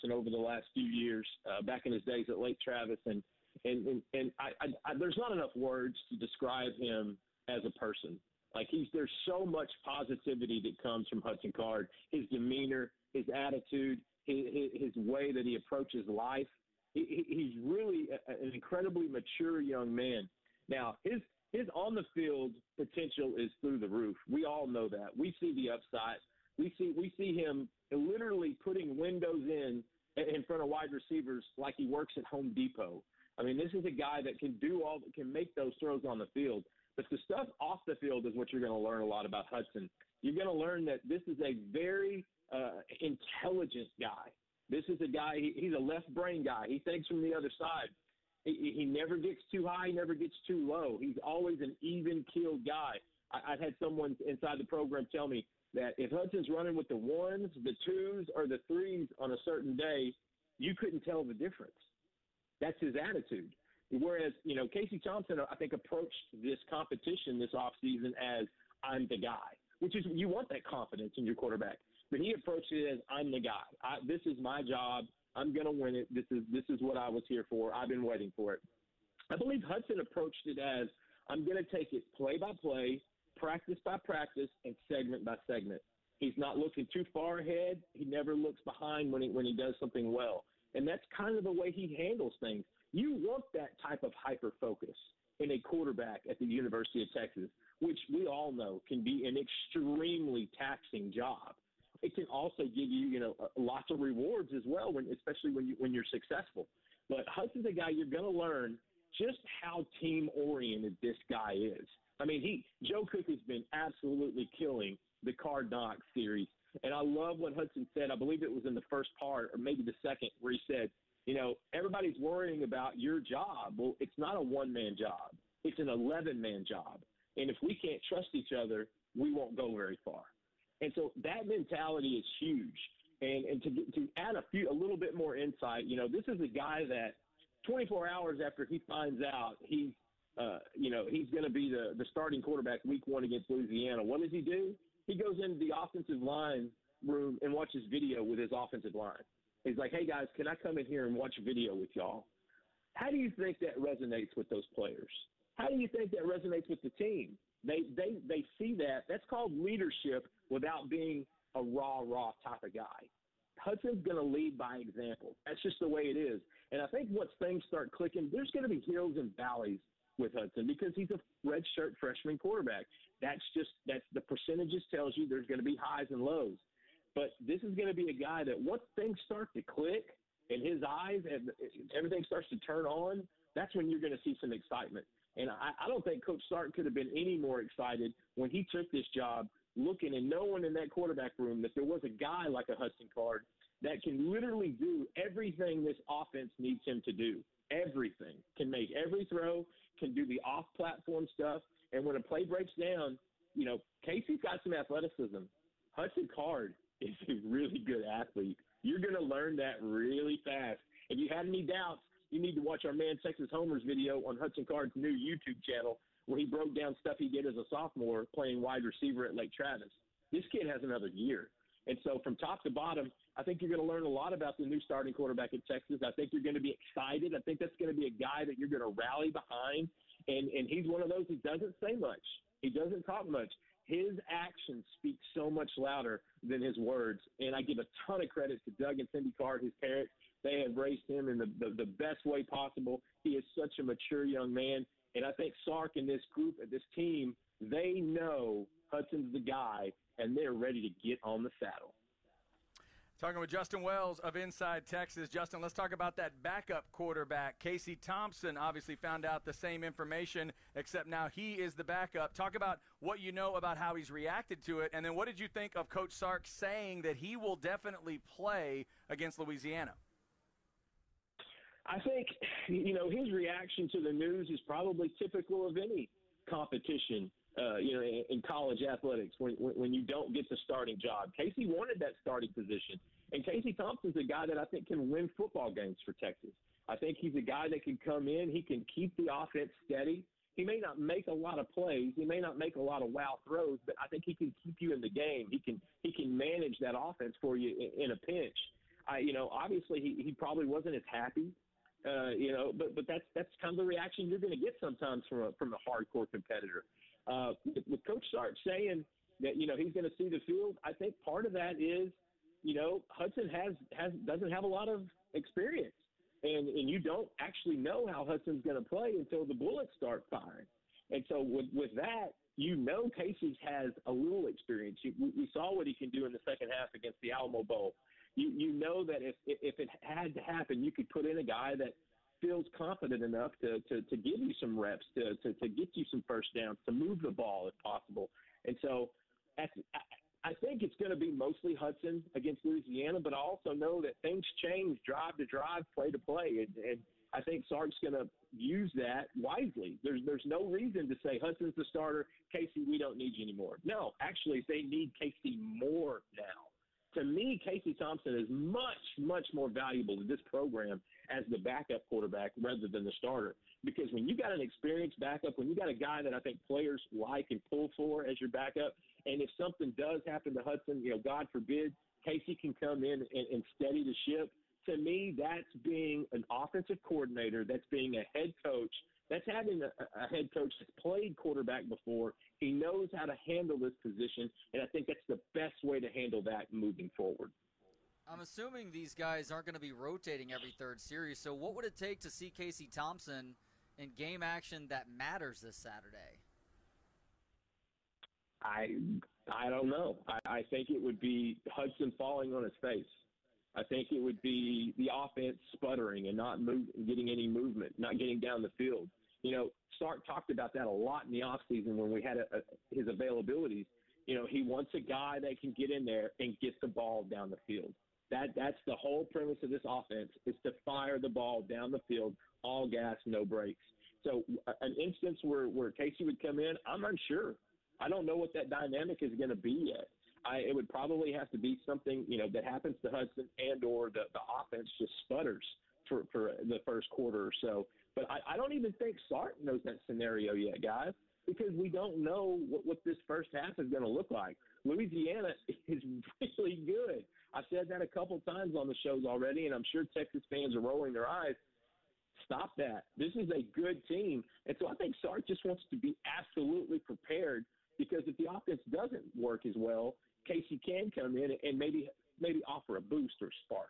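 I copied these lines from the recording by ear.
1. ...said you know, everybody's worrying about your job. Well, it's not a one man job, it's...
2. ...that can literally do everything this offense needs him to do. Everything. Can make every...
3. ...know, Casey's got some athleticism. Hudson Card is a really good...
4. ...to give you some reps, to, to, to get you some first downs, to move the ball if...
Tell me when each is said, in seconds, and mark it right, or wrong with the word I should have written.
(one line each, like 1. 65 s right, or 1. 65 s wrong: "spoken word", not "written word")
1. 120 s right
2. 193 s right
3. 203 s right
4. 334 s right.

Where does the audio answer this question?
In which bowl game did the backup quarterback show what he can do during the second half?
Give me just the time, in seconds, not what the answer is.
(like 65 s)
327 s.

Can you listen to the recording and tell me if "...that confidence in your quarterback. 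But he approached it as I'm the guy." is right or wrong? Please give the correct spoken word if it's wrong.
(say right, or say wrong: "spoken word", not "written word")
right.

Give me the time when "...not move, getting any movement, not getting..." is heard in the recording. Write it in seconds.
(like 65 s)
406 s.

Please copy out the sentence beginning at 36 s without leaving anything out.
But the stuff off the field is what you're going to learn a lot about Hudson.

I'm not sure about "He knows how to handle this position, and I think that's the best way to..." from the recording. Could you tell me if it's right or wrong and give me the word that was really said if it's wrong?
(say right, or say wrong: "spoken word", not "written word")
right.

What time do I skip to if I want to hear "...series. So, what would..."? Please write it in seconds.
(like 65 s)
391 s.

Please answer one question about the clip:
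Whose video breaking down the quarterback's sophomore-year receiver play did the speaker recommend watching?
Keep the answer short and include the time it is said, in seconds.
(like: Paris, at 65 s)
Texas Homer, at 213 s.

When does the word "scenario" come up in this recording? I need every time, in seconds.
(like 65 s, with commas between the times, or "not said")
440 s.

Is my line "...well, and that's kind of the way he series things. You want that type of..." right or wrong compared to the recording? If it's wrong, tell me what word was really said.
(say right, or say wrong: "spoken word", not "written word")
wrong: "handles", not "series".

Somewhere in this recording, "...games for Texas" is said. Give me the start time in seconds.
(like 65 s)
285 s.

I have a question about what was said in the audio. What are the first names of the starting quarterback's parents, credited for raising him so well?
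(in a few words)
Doug and Cindy.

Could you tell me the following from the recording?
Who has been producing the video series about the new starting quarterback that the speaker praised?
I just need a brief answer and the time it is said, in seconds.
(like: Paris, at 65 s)
Joe Cook, at 112 s.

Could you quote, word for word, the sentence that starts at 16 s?
He, he's really a, an incredibly mature young man.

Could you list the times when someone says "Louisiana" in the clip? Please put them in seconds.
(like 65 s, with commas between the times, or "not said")
143 s, 269 s, 342 s, 444 s.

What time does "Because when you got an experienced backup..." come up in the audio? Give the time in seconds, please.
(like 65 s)
363 s.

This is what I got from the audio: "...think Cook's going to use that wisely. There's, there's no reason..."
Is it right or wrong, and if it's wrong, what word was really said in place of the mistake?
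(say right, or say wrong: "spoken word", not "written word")
wrong: "Sark", not "Cook".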